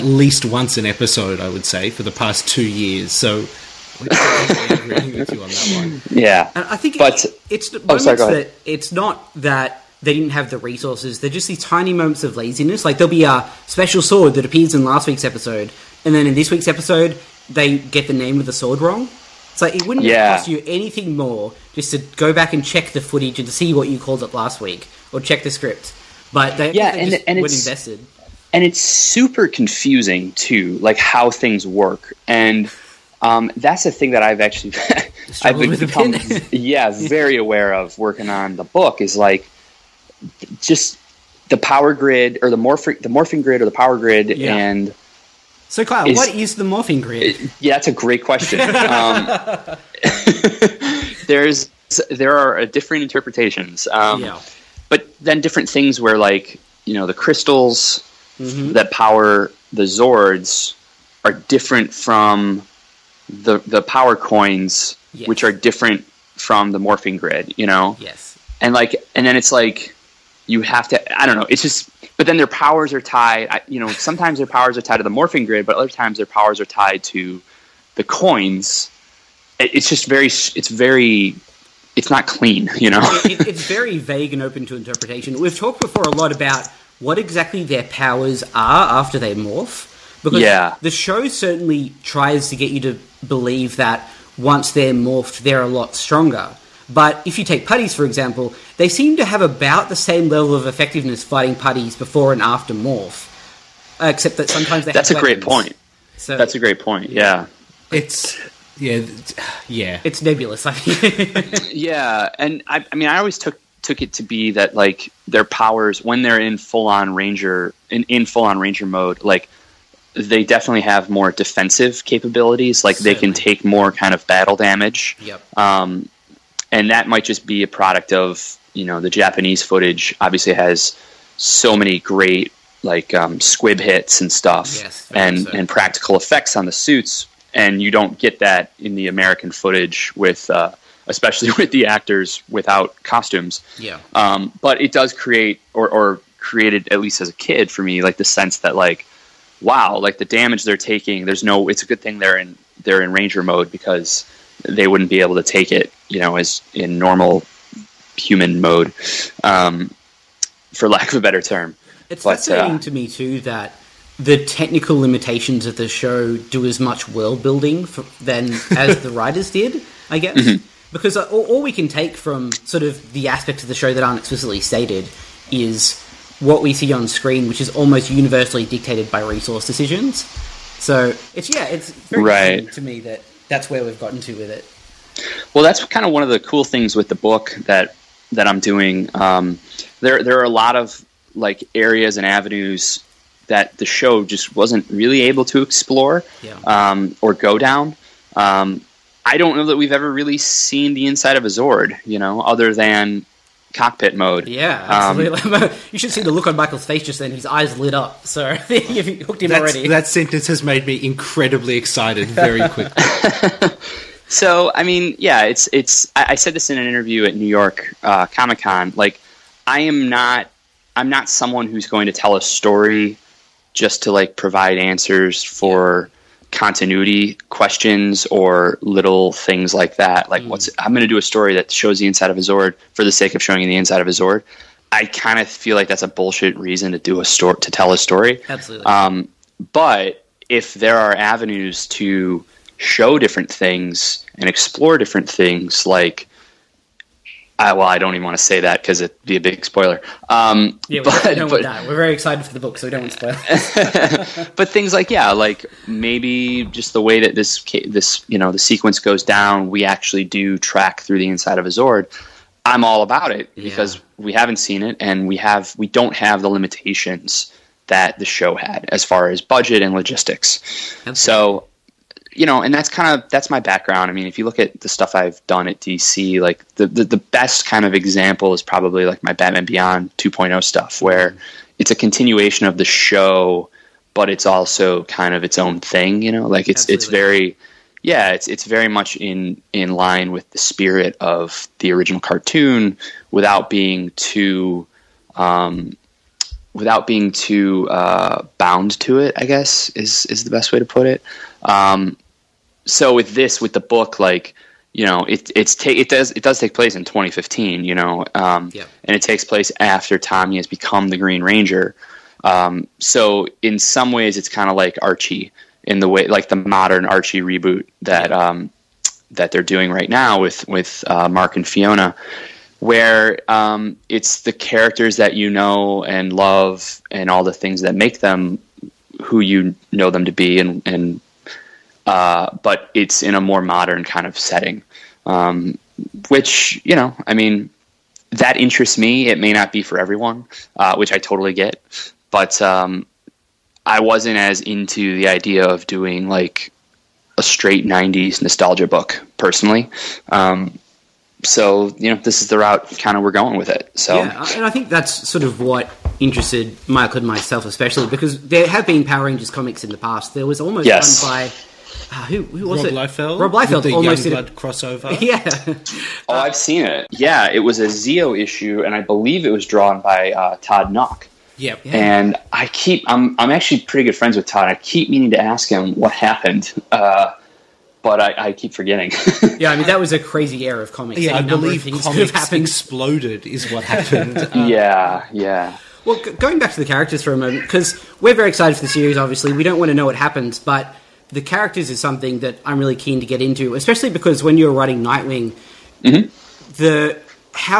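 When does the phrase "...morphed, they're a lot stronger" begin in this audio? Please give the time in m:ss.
1:34.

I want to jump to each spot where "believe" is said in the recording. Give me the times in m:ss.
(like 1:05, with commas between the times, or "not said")
1:33, 6:09, 6:21.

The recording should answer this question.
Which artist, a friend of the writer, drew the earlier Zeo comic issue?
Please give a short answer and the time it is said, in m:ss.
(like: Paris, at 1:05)
Todd Nauck, at 6:10.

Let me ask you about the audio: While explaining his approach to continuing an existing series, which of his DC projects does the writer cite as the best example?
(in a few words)
Batman Beyond 2.0.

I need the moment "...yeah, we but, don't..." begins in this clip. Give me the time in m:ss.
4:10.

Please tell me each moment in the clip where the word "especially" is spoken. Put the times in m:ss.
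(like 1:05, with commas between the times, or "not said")
2:21, 5:57, 6:33.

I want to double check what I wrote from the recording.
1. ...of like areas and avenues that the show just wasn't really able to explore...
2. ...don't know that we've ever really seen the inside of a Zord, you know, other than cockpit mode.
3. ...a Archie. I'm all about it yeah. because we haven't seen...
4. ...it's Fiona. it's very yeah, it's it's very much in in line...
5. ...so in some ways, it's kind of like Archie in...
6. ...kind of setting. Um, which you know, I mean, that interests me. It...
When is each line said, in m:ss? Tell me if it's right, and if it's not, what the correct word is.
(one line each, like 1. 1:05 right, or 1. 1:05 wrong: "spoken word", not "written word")
1. 3:10 right
2. 3:19 right
3. 4:21 wrong: "Zord", not "Archie"
4. 4:46 wrong: "Absolutely", not "Fiona"
5. 5:12 right
6. 5:34 right.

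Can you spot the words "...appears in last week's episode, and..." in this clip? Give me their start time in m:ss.
0:14.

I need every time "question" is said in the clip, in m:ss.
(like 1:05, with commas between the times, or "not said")
0:48, 3:47.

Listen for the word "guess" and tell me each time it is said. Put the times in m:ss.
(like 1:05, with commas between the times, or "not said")
2:50, 4:59.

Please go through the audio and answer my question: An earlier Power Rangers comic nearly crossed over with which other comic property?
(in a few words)
Youngblood.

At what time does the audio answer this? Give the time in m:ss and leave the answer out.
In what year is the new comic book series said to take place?
5:07.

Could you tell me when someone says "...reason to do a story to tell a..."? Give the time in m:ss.
3:56.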